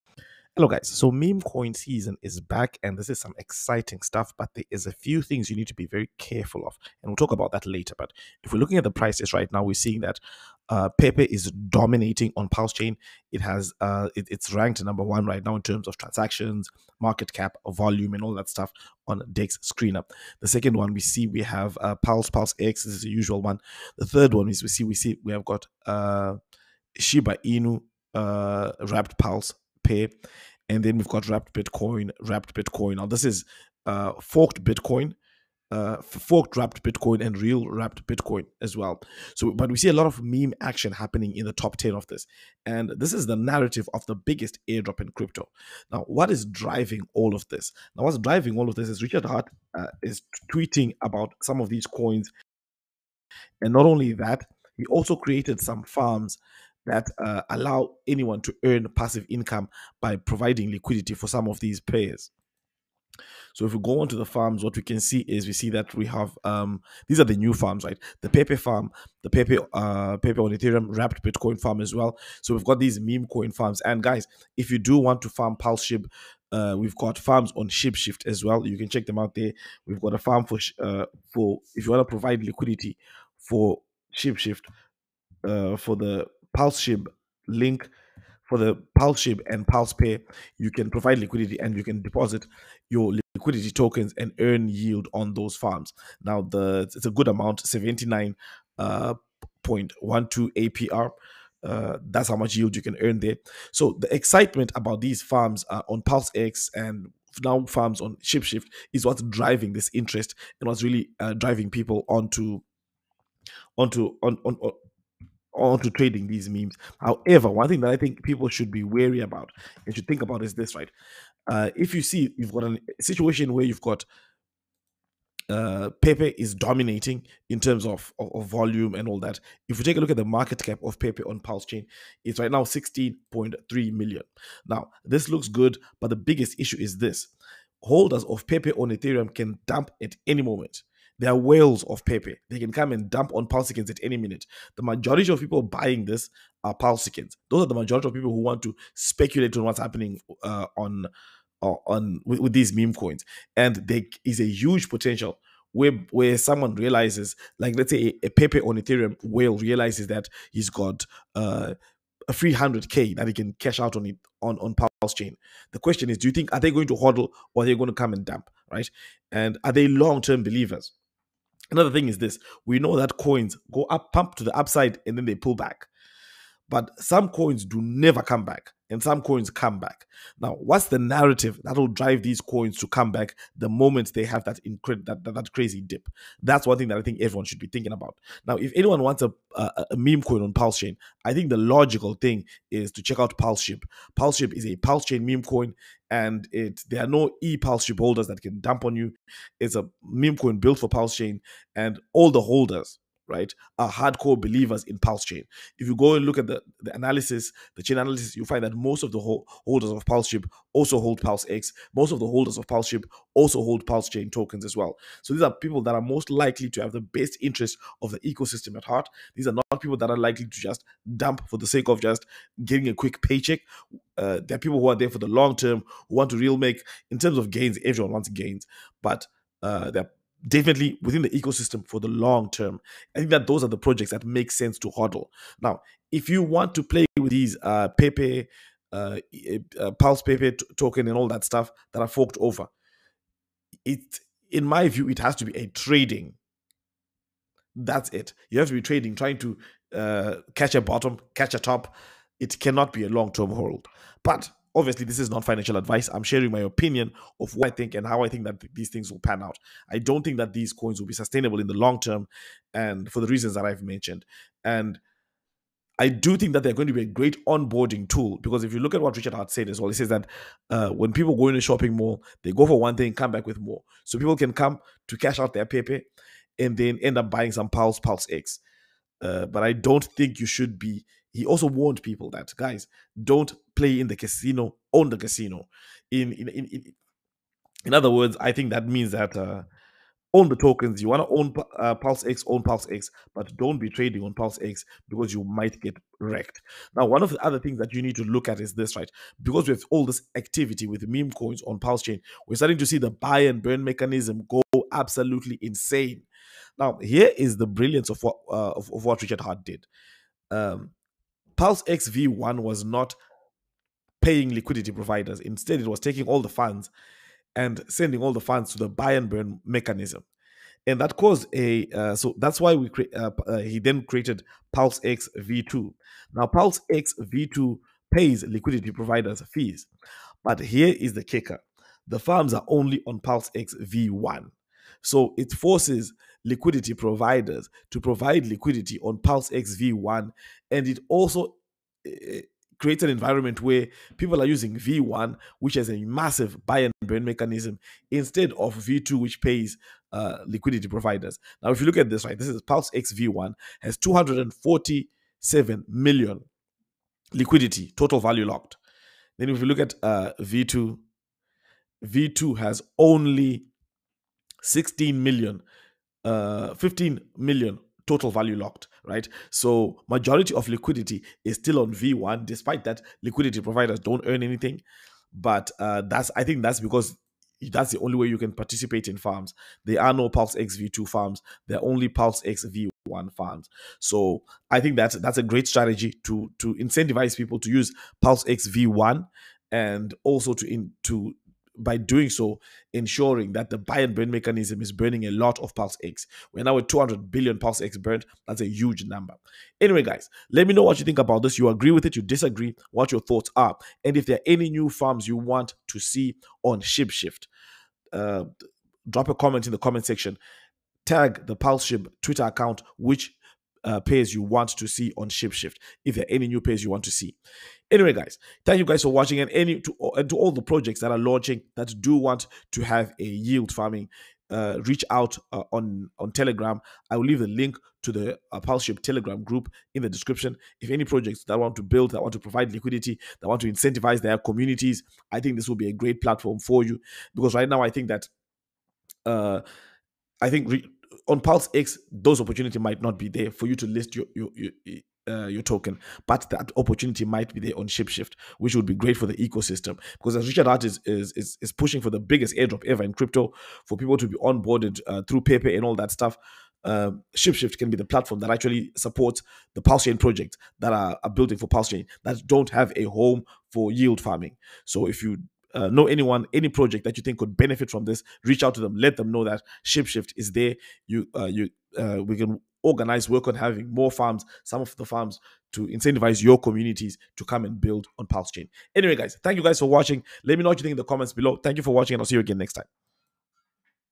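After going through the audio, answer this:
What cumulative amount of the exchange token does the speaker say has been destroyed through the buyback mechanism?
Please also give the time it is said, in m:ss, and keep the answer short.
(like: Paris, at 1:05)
200 billion, at 6:36.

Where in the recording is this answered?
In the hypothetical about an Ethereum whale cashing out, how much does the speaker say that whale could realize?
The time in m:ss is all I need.
2:42.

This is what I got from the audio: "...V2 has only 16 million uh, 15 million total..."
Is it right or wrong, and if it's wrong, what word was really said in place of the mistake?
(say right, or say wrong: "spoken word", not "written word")
right.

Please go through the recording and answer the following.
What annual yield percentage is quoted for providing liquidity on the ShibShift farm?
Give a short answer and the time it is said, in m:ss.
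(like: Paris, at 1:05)
79.12, at 1:37.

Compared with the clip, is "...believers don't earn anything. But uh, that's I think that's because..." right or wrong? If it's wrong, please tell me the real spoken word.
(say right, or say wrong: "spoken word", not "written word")
wrong: "providers", not "believers".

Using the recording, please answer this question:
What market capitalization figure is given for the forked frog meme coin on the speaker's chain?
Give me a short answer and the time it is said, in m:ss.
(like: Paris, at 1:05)
16.3 million, at 2:12.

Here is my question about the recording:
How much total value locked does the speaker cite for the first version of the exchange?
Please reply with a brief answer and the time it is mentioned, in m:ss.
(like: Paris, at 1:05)
247 million, at 5:53.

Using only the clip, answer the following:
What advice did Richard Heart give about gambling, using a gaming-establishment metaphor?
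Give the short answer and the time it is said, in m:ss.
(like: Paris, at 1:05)
own the casino, at 4:44.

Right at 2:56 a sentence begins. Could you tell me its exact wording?
But some coins do never come back and some coins come back.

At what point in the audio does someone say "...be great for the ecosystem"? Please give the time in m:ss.
7:28.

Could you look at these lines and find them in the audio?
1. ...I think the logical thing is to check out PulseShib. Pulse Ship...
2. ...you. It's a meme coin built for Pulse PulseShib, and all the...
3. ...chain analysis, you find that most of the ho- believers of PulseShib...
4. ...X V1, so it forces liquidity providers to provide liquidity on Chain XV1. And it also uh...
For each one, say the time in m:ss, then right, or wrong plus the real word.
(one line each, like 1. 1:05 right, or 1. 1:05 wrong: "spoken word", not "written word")
1. 3:11 right
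2. 3:18 wrong: "Chain", not "PulseShib"
3. 3:27 wrong: "holders", not "believers"
4. 5:33 wrong: "Pulse", not "Chain".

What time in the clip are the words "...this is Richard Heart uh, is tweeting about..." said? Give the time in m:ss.
0:48.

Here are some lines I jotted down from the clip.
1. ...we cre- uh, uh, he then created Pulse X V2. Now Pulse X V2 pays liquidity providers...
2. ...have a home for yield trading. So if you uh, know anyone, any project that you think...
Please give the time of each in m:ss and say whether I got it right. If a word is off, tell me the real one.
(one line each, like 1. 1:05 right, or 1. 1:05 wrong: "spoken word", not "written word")
1. 5:22 right
2. 7:42 wrong: "farming", not "trading".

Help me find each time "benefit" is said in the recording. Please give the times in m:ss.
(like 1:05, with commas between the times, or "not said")
7:47.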